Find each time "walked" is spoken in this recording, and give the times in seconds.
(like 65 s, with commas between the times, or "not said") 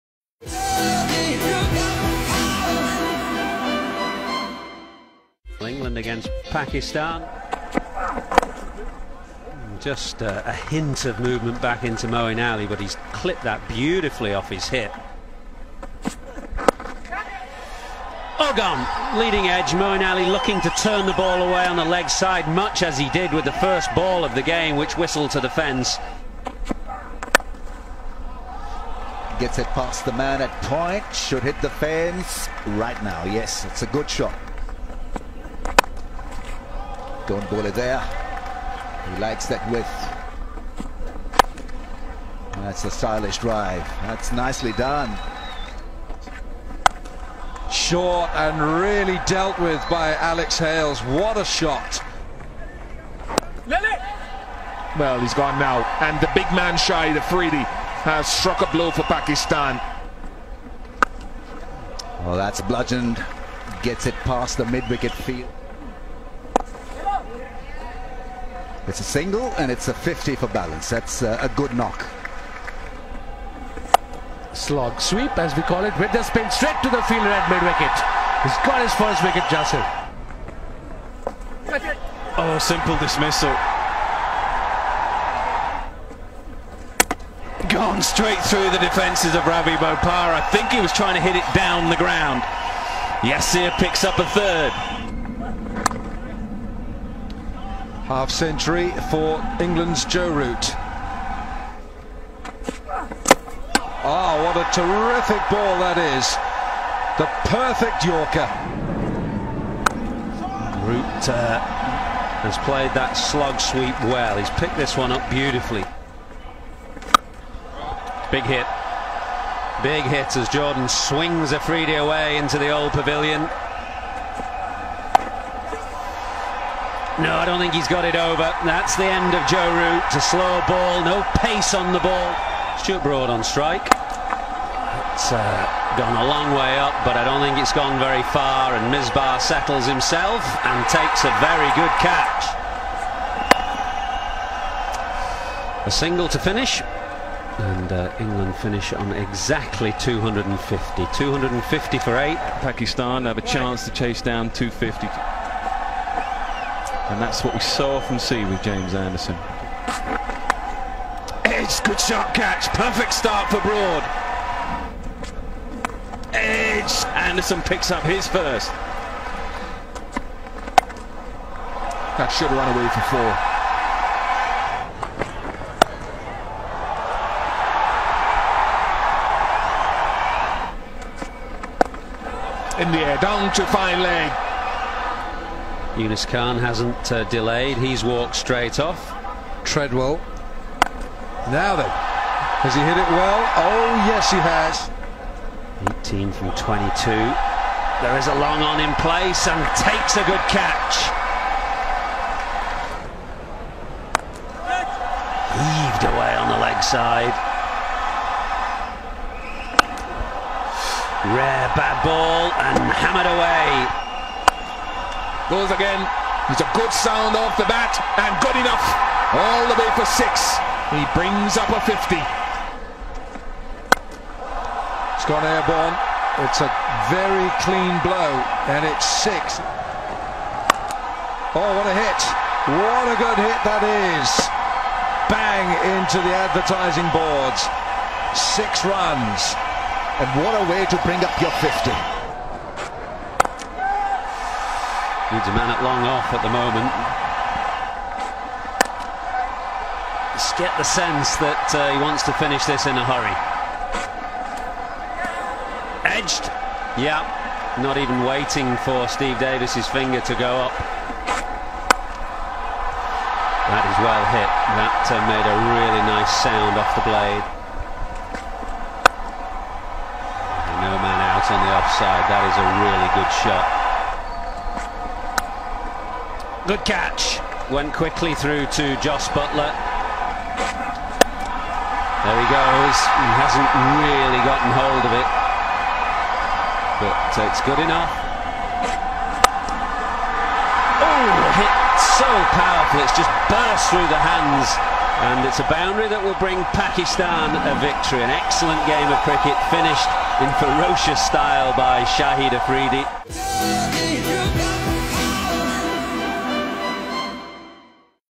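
188 s.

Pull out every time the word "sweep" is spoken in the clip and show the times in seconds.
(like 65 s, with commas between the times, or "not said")
74 s, 113 s.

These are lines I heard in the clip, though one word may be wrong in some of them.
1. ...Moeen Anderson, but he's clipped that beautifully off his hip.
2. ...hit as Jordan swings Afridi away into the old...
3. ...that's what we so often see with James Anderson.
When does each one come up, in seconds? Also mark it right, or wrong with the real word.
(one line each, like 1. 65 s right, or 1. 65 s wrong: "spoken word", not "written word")
1. 12 s wrong: "Ali", not "Anderson"
2. 120 s right
3. 157 s right.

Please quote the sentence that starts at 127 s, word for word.
No, I don't think he's got it over.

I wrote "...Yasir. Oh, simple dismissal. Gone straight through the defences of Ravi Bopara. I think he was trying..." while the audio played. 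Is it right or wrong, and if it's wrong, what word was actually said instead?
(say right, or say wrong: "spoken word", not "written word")
right.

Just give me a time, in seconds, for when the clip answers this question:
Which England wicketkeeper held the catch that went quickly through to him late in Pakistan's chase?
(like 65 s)
279 s.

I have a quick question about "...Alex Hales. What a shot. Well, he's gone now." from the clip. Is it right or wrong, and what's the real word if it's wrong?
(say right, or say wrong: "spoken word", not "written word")
right.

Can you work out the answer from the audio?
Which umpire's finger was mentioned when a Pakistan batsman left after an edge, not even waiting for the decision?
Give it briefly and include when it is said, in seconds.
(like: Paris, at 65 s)
Steve Davis, at 259 s.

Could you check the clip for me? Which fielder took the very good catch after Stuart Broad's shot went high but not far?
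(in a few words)
Misbah.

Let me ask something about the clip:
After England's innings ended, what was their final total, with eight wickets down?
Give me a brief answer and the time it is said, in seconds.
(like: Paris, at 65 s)
250, at 151 s.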